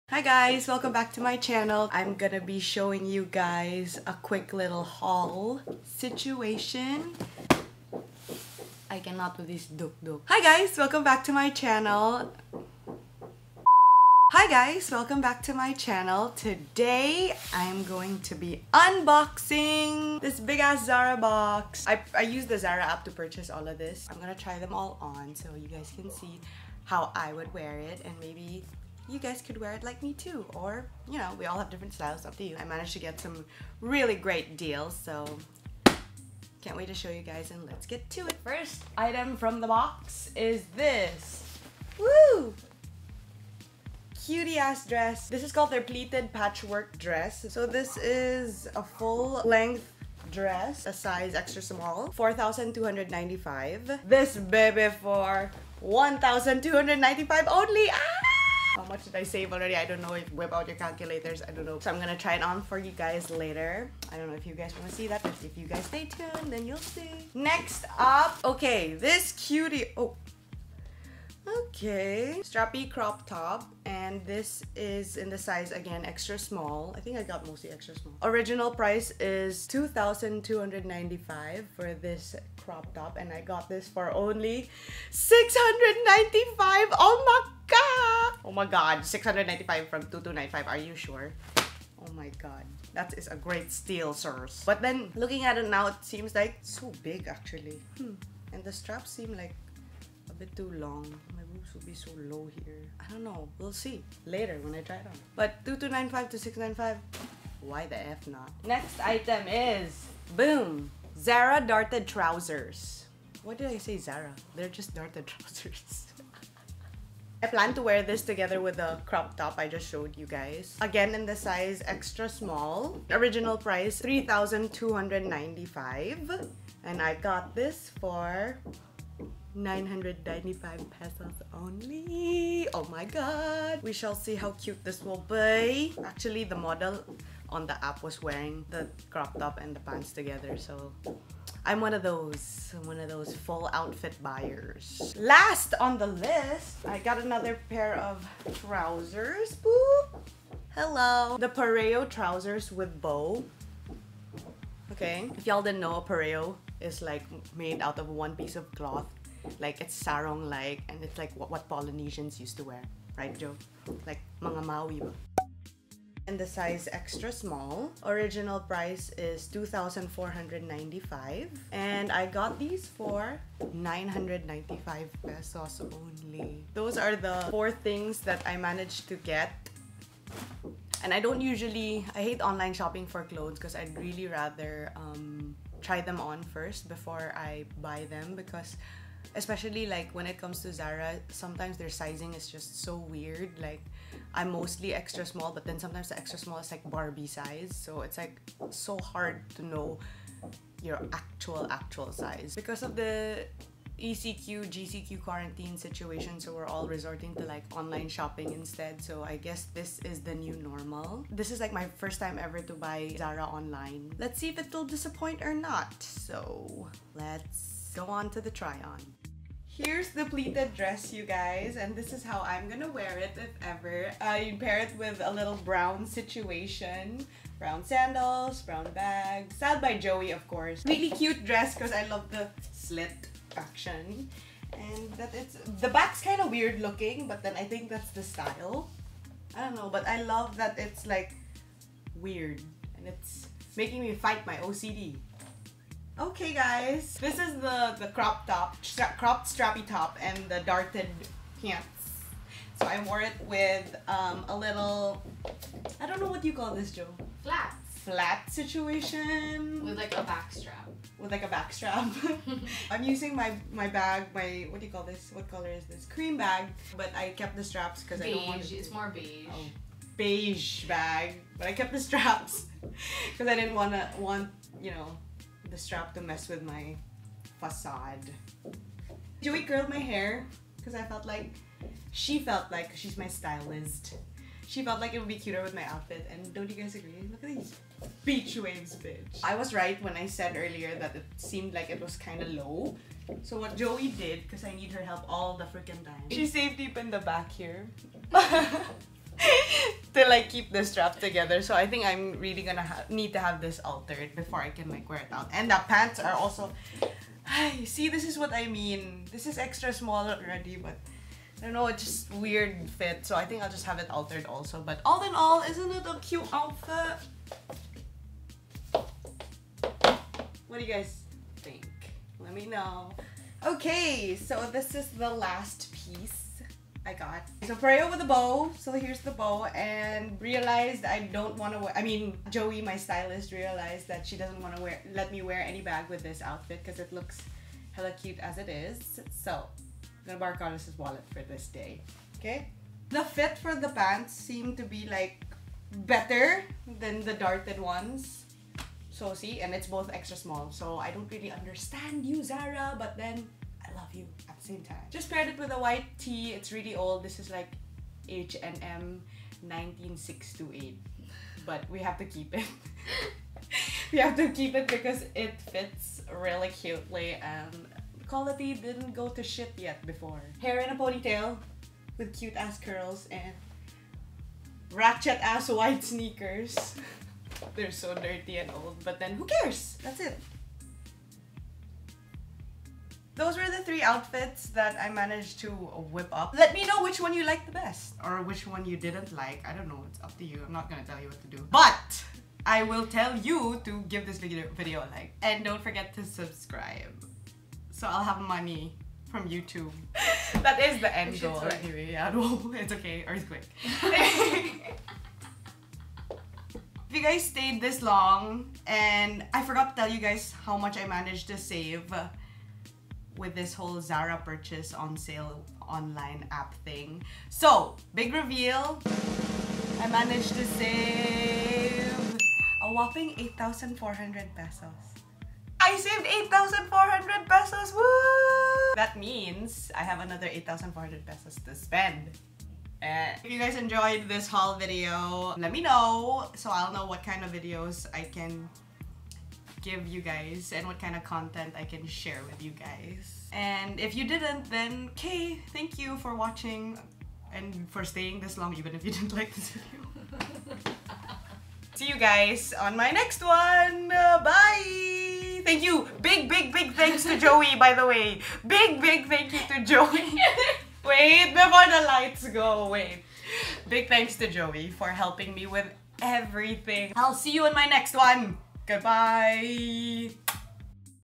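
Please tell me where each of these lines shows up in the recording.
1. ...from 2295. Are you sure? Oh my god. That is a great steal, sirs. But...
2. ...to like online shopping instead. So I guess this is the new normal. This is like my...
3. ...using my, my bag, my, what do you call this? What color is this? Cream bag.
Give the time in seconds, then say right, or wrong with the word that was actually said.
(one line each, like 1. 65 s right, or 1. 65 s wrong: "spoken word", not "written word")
1. 89 s right
2. 207 s right
3. 263 s right.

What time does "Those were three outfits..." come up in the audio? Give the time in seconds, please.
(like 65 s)
383 s.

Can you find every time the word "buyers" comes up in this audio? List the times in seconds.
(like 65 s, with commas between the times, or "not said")
144 s.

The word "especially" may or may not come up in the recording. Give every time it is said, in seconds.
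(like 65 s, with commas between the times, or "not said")
189 s.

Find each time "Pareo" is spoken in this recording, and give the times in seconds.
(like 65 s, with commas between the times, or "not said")
151 s, 156 s, 327 s.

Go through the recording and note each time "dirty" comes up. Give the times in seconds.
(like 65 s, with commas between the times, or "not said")
378 s.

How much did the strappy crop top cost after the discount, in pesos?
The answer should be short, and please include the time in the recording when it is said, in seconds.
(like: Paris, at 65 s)
695, at 83 s.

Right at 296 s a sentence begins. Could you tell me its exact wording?
She saved deep in the back here.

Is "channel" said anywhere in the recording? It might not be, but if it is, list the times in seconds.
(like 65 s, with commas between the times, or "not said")
1 s, 11 s, 15 s.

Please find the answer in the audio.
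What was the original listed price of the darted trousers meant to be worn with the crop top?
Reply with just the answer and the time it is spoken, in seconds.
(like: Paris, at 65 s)
3,295, at 123 s.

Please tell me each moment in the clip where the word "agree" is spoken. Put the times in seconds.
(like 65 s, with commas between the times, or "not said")
286 s.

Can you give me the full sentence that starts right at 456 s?
Big, big, big thanks to Joie, by the way.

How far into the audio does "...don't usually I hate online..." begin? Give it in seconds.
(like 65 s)
181 s.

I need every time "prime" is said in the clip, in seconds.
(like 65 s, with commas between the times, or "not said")
not said.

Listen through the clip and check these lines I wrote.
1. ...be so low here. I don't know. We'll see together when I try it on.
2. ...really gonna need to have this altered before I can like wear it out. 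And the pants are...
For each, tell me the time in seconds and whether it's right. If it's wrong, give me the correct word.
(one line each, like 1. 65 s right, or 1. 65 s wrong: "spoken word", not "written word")
1. 101 s wrong: "later", not "together"
2. 302 s right.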